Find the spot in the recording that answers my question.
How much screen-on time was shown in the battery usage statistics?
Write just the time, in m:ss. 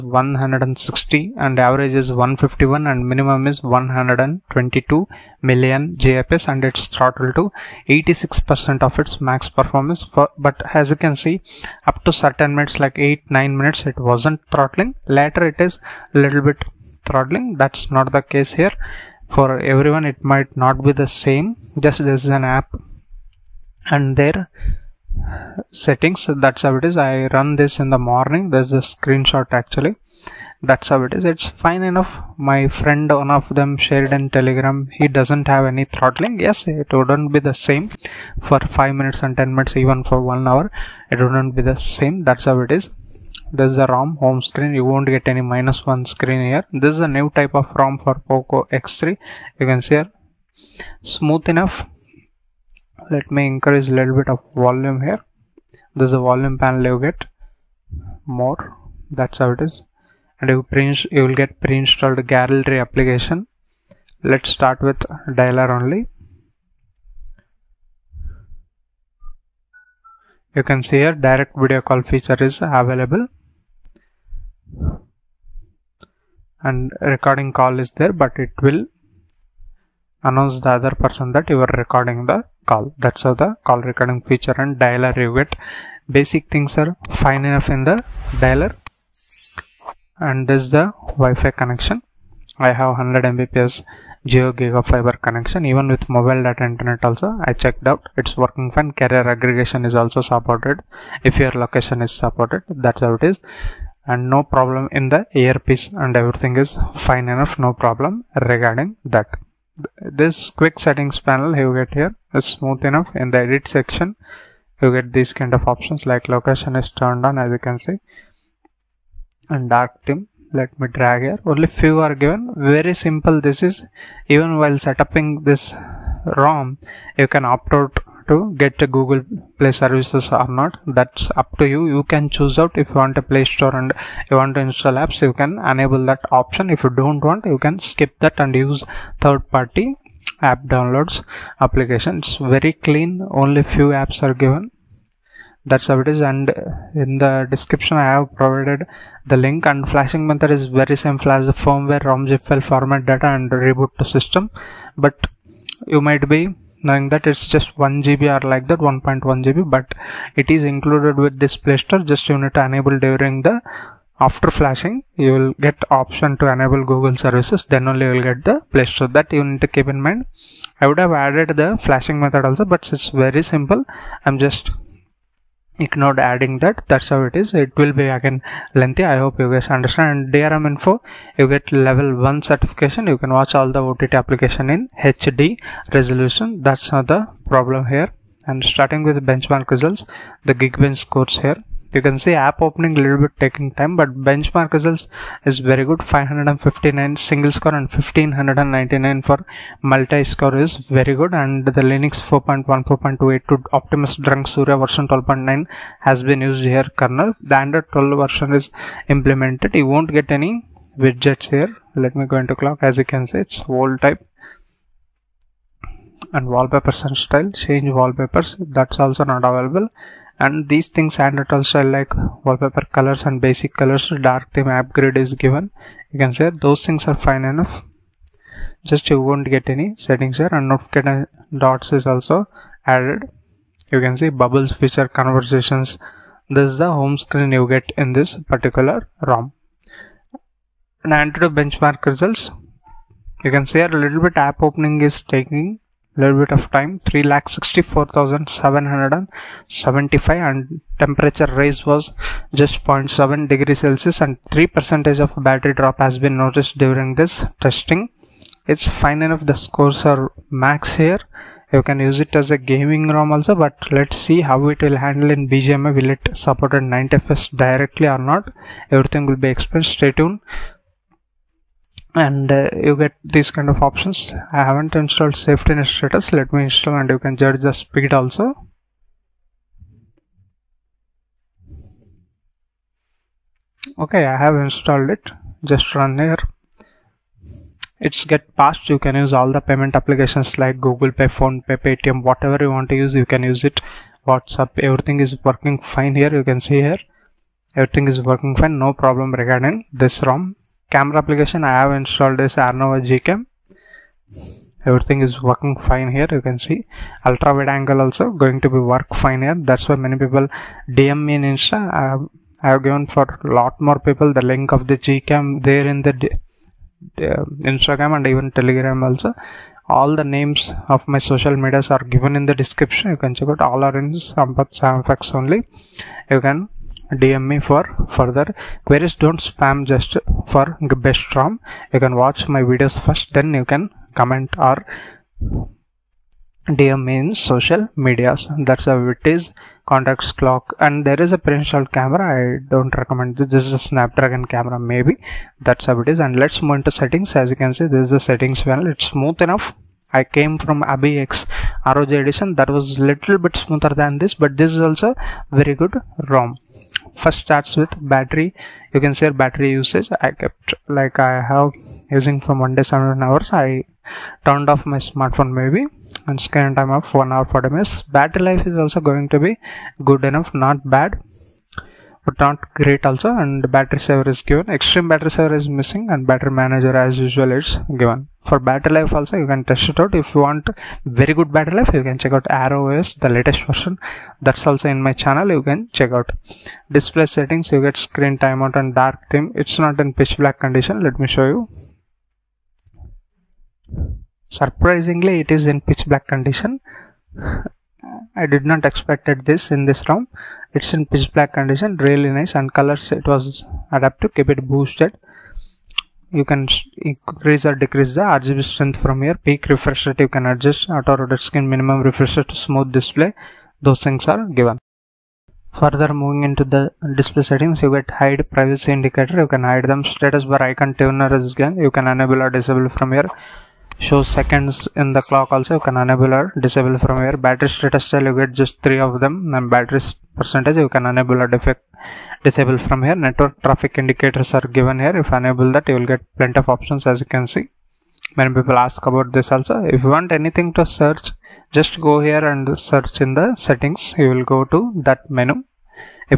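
6:07.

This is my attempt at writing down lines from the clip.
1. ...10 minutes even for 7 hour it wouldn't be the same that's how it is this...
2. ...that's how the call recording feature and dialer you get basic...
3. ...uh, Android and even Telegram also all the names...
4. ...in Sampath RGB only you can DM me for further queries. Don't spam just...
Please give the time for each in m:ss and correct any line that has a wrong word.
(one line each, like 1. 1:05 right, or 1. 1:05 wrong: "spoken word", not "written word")
1. 0:39 wrong: "1", not "7"
2. 1:23 right
3. 5:17 wrong: "Instagram", not "Android"
4. 5:23 wrong: "SamFX", not "RGB".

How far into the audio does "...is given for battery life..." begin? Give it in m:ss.
6:17.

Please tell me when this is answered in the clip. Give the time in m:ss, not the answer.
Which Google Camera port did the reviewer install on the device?
5:02.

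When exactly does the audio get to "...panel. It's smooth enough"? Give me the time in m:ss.
5:48.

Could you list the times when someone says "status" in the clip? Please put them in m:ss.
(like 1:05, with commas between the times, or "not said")
4:35, 7:00, 7:07.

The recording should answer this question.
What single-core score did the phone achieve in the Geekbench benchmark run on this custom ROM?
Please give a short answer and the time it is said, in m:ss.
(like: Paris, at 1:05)
559, at 3:16.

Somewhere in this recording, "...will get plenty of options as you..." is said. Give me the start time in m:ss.
7:15.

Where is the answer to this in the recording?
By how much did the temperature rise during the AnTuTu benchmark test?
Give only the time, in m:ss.
4:12.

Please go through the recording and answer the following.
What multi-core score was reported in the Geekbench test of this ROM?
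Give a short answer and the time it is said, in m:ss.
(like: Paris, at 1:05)
1599, at 3:18.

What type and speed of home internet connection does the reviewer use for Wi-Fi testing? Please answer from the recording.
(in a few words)
100 Mbps Jio GigaFiber.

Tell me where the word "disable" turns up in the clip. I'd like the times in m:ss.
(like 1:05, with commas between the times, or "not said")
7:02, 7:06, 7:12.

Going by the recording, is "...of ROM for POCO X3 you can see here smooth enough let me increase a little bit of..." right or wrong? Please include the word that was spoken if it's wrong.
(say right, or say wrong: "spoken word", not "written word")
right.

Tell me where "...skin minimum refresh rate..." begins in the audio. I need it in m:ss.
6:51.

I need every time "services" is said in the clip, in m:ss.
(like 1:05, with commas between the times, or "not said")
2:09, 2:47.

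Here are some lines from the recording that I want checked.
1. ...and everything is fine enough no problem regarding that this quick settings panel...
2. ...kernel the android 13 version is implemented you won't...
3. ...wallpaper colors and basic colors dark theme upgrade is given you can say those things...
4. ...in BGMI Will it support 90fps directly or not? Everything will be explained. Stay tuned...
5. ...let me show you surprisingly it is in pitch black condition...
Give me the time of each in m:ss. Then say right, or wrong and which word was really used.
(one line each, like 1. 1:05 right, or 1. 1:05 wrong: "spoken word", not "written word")
1. 1:45 right
2. 3:27 wrong: "12", not "13"
3. 3:42 right
4. 4:25 right
5. 6:31 right.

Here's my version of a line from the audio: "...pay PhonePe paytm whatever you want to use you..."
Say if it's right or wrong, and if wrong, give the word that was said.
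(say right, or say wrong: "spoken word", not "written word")
right.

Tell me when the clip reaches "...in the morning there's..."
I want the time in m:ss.
0:27.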